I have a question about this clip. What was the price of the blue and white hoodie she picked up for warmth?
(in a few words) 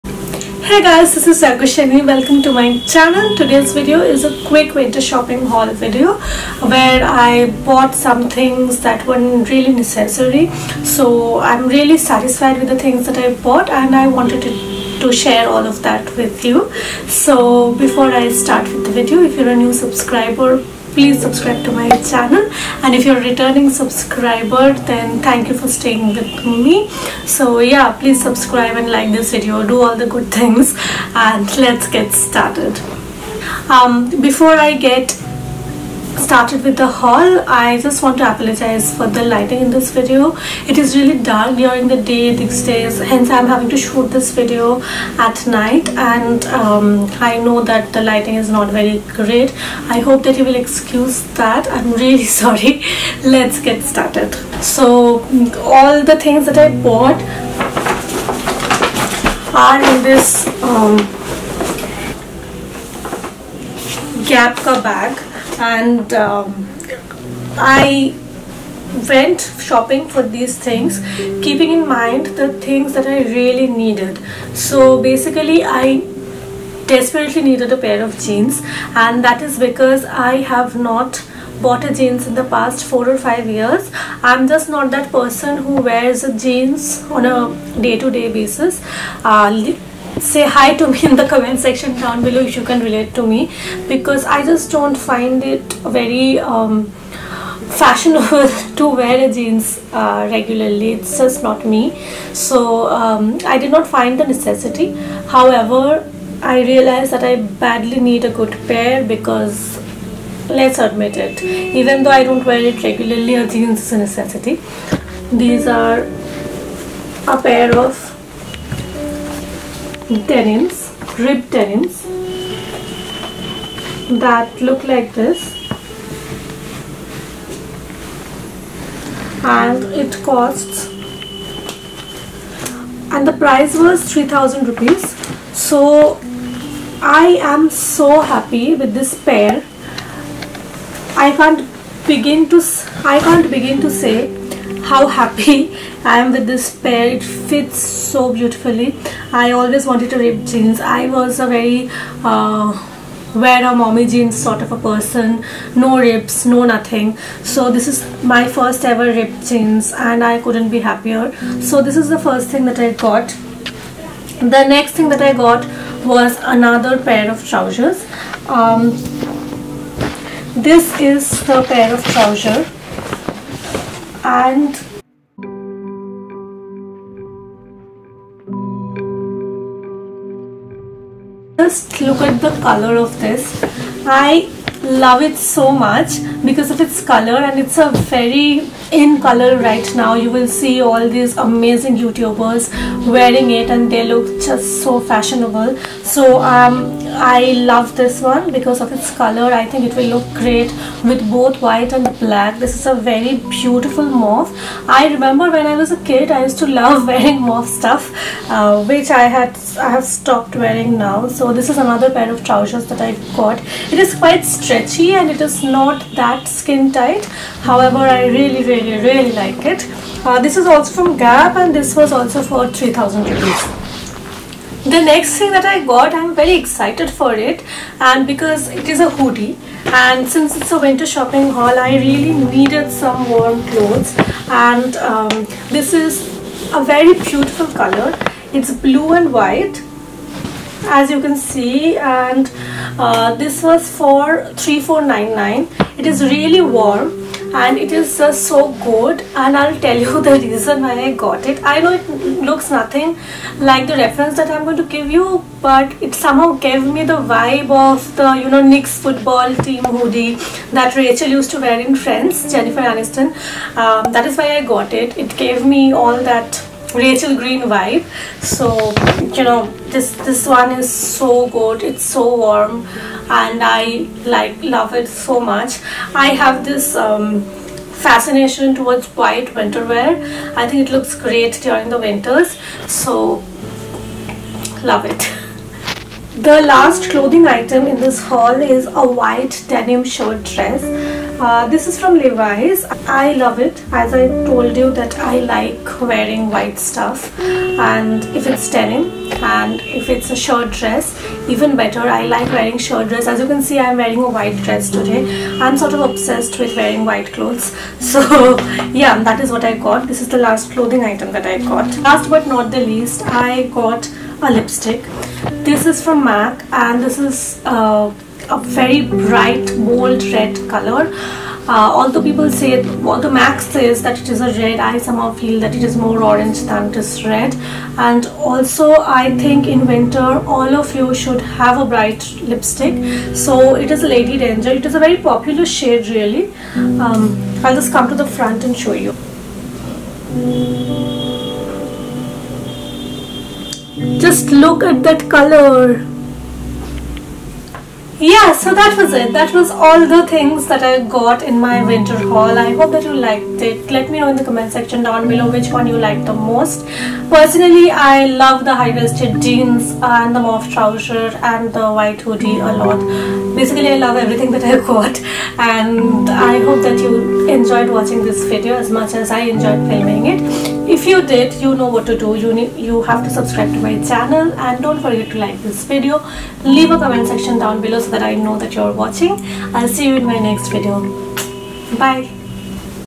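3499.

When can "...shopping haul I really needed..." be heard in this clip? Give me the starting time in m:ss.
3:51.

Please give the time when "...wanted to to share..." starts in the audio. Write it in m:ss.
0:14.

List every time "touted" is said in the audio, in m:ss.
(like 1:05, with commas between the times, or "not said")
not said.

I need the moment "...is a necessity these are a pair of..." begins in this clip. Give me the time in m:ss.
1:53.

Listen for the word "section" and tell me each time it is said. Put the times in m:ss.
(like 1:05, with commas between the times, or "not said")
1:31, 5:54, 6:17.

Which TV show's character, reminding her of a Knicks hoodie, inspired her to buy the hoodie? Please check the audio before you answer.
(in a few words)
Friends.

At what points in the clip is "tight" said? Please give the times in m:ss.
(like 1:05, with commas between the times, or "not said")
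3:36.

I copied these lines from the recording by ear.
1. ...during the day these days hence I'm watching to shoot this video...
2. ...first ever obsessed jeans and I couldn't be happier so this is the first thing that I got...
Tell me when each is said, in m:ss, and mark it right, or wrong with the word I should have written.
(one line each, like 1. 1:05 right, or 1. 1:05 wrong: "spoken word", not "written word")
1. 0:41 wrong: "having", not "watching"
2. 2:38 wrong: "ripped", not "obsessed".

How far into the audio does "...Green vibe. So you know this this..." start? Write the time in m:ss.
4:27.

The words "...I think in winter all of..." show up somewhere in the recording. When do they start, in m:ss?
5:29.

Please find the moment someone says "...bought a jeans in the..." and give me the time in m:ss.
1:21.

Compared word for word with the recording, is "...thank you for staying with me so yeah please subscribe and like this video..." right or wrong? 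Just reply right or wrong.
right.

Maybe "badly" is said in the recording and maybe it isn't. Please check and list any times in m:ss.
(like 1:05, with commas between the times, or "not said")
1:47.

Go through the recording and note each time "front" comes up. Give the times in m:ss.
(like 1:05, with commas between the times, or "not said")
5:38.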